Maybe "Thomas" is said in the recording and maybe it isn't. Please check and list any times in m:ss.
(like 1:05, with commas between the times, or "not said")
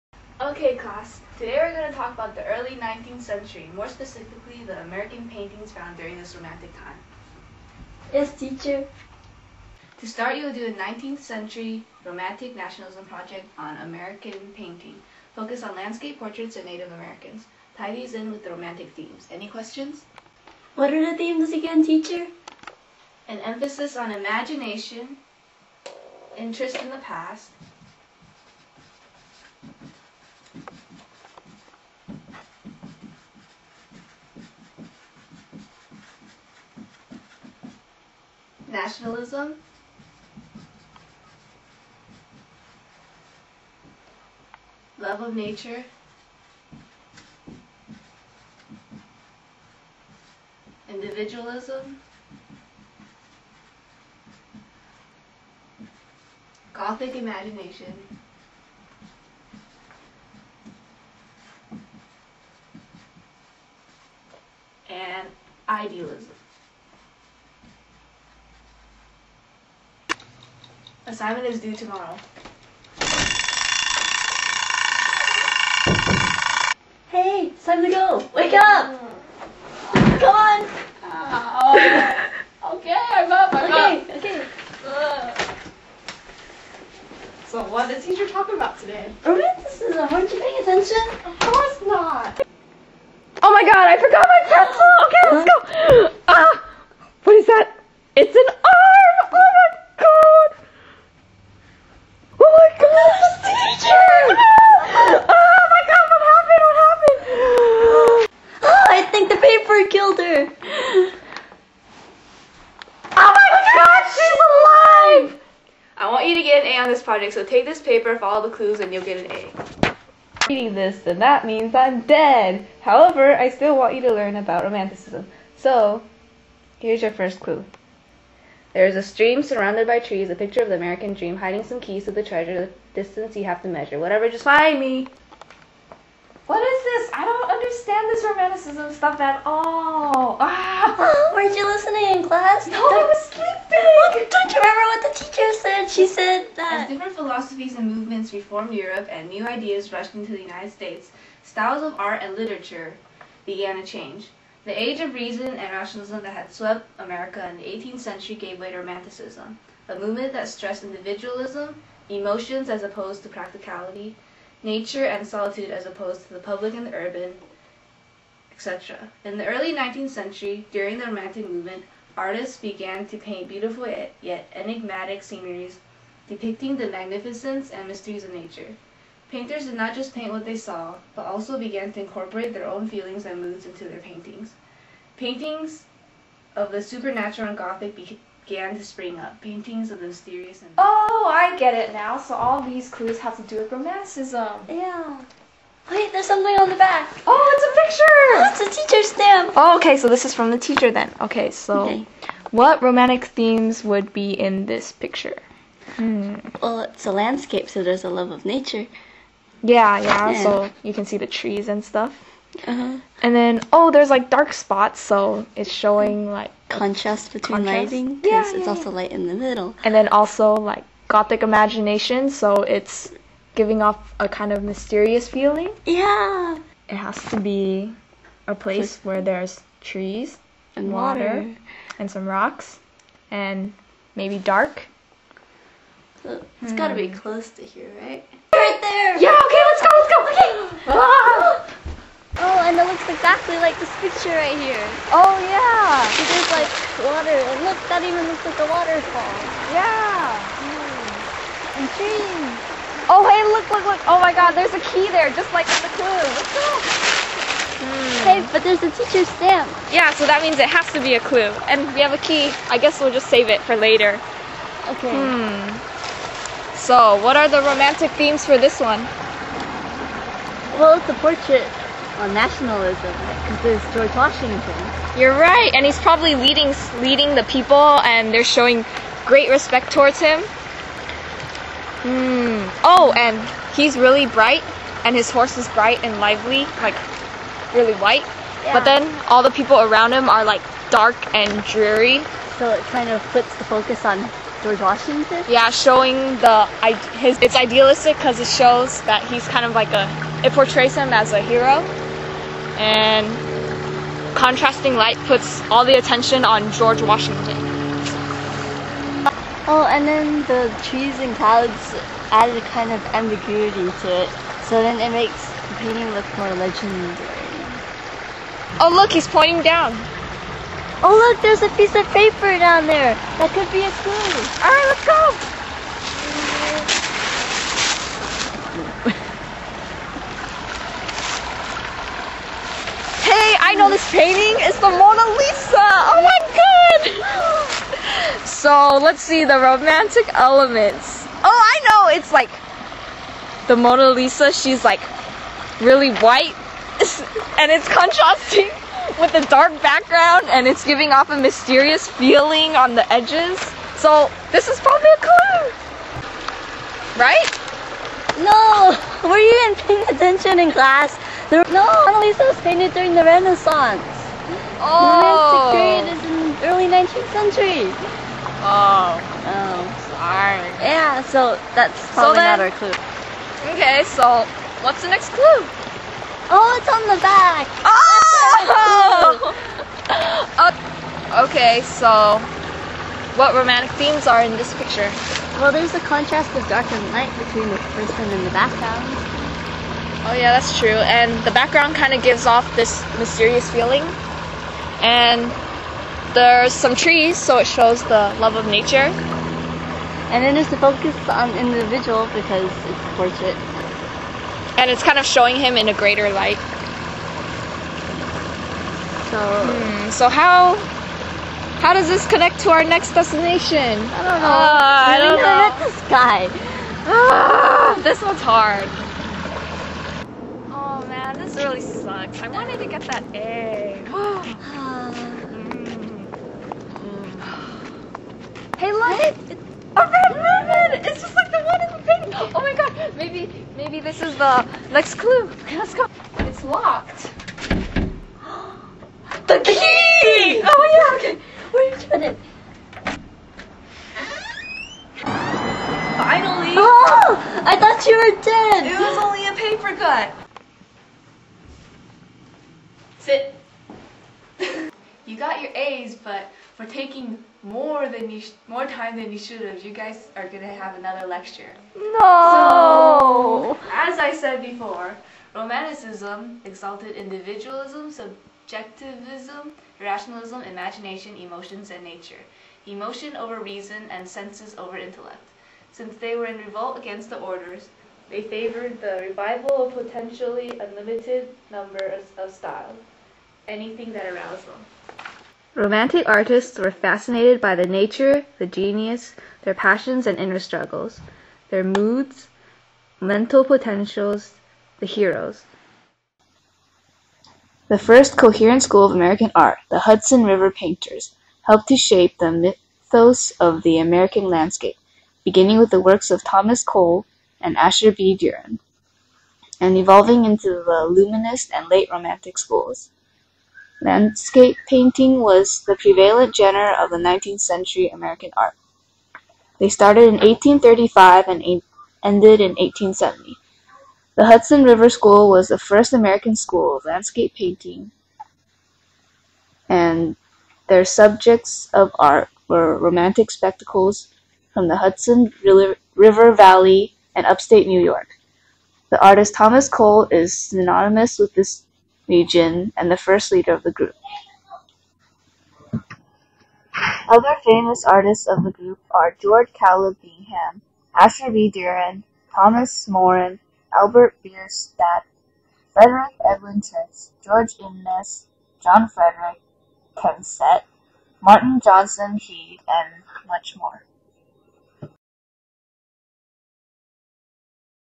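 8:26, 8:59, 9:12.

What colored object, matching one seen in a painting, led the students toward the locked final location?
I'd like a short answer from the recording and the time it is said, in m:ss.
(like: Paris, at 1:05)
A red ribbon, at 7:09.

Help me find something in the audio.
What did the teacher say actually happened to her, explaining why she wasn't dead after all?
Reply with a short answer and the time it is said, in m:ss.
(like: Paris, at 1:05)
A paper cut, at 7:29.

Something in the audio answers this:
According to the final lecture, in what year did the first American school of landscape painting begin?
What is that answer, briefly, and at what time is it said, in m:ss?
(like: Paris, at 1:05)
1835, at 8:40.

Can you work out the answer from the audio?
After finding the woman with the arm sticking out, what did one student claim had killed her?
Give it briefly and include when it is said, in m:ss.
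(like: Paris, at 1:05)
The paper, at 1:49.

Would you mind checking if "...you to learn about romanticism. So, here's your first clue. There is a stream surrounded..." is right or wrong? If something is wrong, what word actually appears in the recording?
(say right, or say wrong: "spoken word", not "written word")
right.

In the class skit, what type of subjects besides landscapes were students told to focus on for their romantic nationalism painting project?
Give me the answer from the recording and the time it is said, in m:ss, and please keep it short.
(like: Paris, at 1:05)
Portraits of Native Americans, at 0:16.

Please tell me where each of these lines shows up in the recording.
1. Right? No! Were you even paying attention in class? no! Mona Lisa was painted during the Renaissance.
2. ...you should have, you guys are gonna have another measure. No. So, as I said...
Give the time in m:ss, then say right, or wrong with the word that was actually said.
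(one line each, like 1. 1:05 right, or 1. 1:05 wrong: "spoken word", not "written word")
1. 5:57 right
2. 7:39 wrong: "lecture", not "measure".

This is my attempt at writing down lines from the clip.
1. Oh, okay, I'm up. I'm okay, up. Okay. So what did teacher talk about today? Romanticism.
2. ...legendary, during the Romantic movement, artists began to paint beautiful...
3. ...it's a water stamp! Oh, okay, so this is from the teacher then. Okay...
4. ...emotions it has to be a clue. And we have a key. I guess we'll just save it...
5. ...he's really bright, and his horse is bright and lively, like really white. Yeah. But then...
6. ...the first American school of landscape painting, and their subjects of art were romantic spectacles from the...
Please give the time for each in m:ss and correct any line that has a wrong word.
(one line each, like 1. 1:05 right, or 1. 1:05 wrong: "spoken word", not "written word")
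1. 1:21 right
2. 2:50 wrong: "century", not "legendary"
3. 3:18 wrong: "teacher", not "water"
4. 4:20 wrong: "means", not "emotions"
5. 4:43 right
6. 8:45 right.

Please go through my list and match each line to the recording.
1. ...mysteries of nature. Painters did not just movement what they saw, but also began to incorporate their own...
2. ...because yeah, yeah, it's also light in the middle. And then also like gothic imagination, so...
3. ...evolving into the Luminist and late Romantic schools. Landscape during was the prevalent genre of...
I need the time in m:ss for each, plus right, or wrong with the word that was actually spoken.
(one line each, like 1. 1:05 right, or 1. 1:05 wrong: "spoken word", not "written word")
1. 2:57 wrong: "paint", not "movement"
2. 3:38 right
3. 8:29 wrong: "painting", not "during".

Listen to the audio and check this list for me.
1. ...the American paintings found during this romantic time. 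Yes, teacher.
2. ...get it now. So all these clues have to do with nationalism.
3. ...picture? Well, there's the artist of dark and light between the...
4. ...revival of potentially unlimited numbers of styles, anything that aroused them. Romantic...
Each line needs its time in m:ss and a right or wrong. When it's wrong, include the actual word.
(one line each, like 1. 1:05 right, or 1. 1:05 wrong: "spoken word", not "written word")
1. 0:04 right
2. 3:11 wrong: "romanticism", not "nationalism"
3. 6:24 wrong: "contrast", not "artist"
4. 7:59 right.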